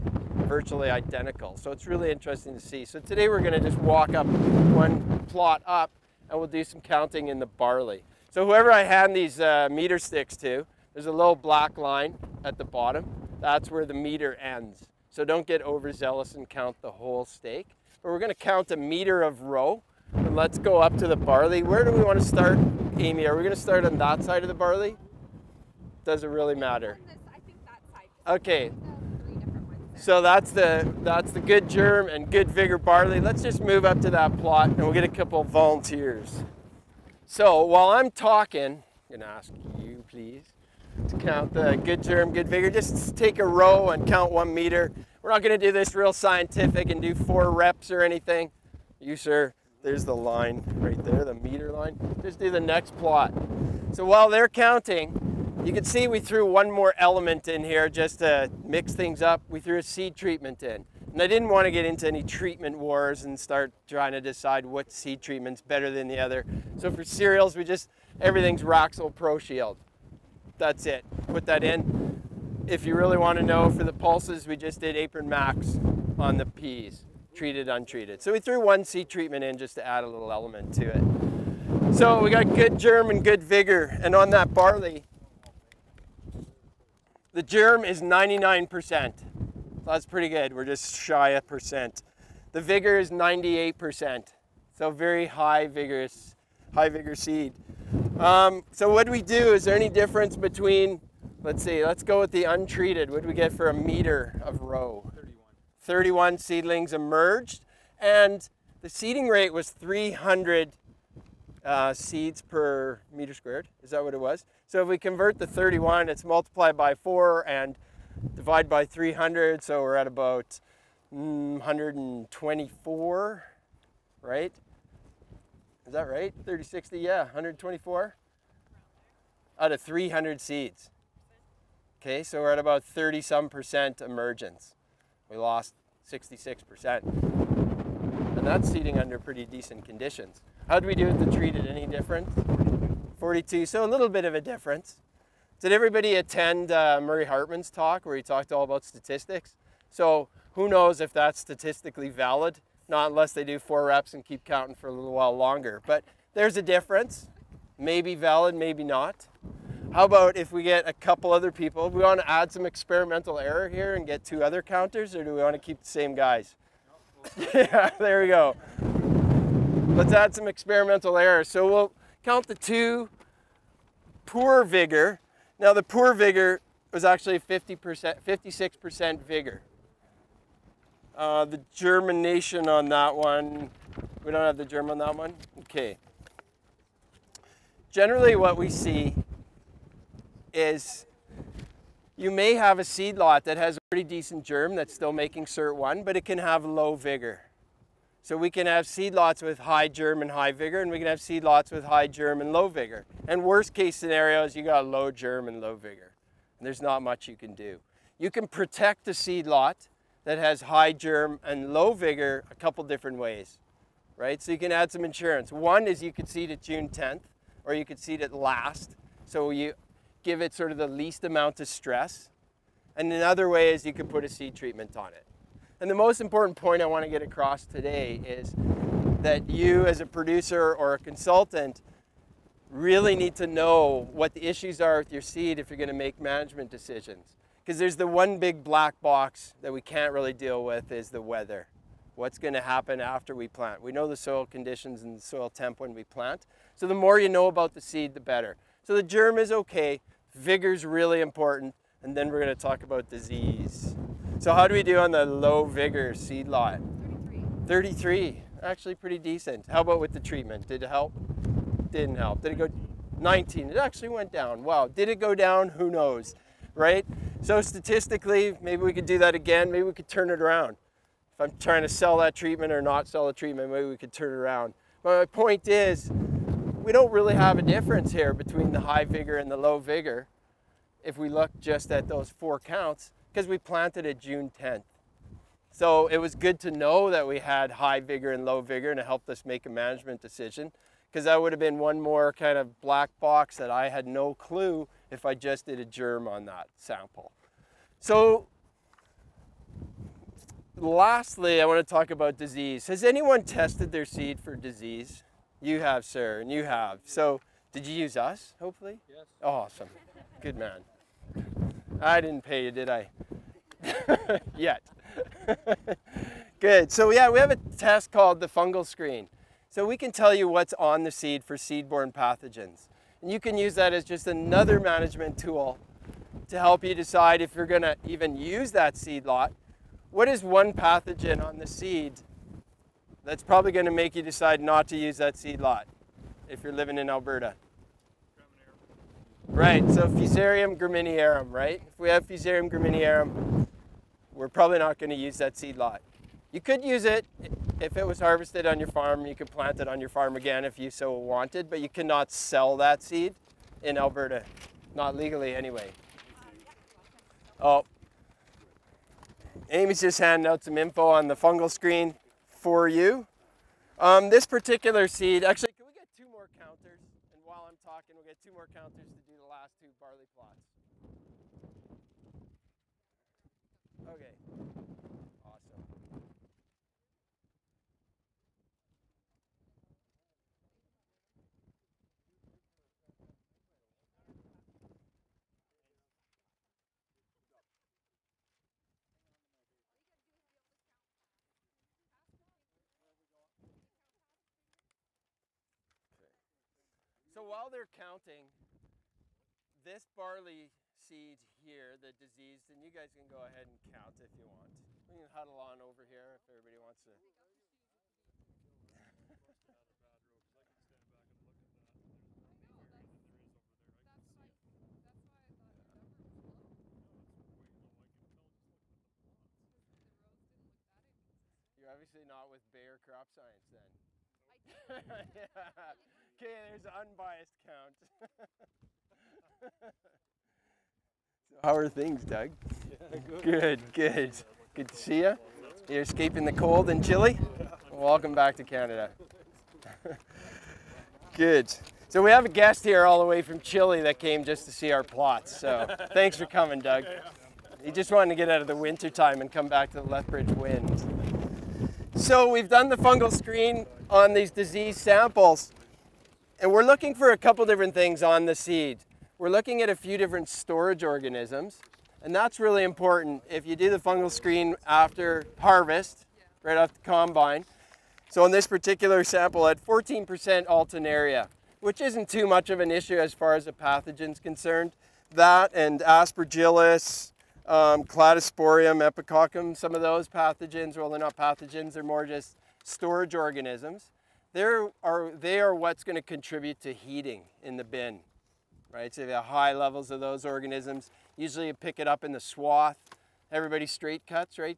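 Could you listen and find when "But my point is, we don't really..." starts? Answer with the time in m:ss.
4:35.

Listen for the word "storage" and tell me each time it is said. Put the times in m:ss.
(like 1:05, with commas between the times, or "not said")
7:40, 8:02.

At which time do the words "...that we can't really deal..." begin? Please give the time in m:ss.
3:59.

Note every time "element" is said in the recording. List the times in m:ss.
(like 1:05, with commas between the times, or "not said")
0:56, 1:20.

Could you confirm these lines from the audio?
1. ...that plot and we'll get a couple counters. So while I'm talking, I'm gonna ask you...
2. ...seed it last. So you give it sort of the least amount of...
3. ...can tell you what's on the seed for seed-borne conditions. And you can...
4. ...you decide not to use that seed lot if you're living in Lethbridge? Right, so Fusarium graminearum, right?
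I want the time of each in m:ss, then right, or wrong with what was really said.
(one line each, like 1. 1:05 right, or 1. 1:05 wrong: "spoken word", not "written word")
1. 0:34 wrong: "volunteers", not "counters"
2. 3:37 right
3. 5:19 wrong: "pathogens", not "conditions"
4. 5:34 wrong: "Alberta", not "Lethbridge".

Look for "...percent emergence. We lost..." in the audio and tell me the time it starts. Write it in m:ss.
2:13.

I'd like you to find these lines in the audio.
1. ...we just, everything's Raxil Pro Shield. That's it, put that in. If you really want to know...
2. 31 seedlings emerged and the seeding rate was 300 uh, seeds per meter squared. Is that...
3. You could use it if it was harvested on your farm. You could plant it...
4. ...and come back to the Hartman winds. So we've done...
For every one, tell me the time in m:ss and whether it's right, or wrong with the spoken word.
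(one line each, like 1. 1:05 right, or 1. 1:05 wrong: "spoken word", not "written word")
1. 1:07 right
2. 1:45 right
3. 5:46 right
4. 7:29 wrong: "Lethbridge", not "Hartman".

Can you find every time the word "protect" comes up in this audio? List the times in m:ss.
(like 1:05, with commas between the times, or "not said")
3:28.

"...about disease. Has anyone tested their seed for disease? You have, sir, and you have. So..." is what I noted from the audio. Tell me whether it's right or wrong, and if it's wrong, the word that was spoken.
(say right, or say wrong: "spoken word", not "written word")
right.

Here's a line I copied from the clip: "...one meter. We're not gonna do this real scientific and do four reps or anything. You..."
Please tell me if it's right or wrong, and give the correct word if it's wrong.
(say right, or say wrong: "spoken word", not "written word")
right.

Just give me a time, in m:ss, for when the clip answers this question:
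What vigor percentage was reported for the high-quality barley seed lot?
1:33.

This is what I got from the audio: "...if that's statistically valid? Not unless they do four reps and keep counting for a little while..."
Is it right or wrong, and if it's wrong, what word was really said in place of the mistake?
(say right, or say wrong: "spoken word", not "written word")
right.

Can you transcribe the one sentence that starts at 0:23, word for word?
Are we going to start on that side of the barley?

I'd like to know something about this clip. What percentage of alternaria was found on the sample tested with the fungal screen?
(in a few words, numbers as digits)
14%.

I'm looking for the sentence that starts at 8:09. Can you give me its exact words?
So you have high levels of those organisms.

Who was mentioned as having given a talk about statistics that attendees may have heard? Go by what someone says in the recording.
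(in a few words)
Murray Hartman.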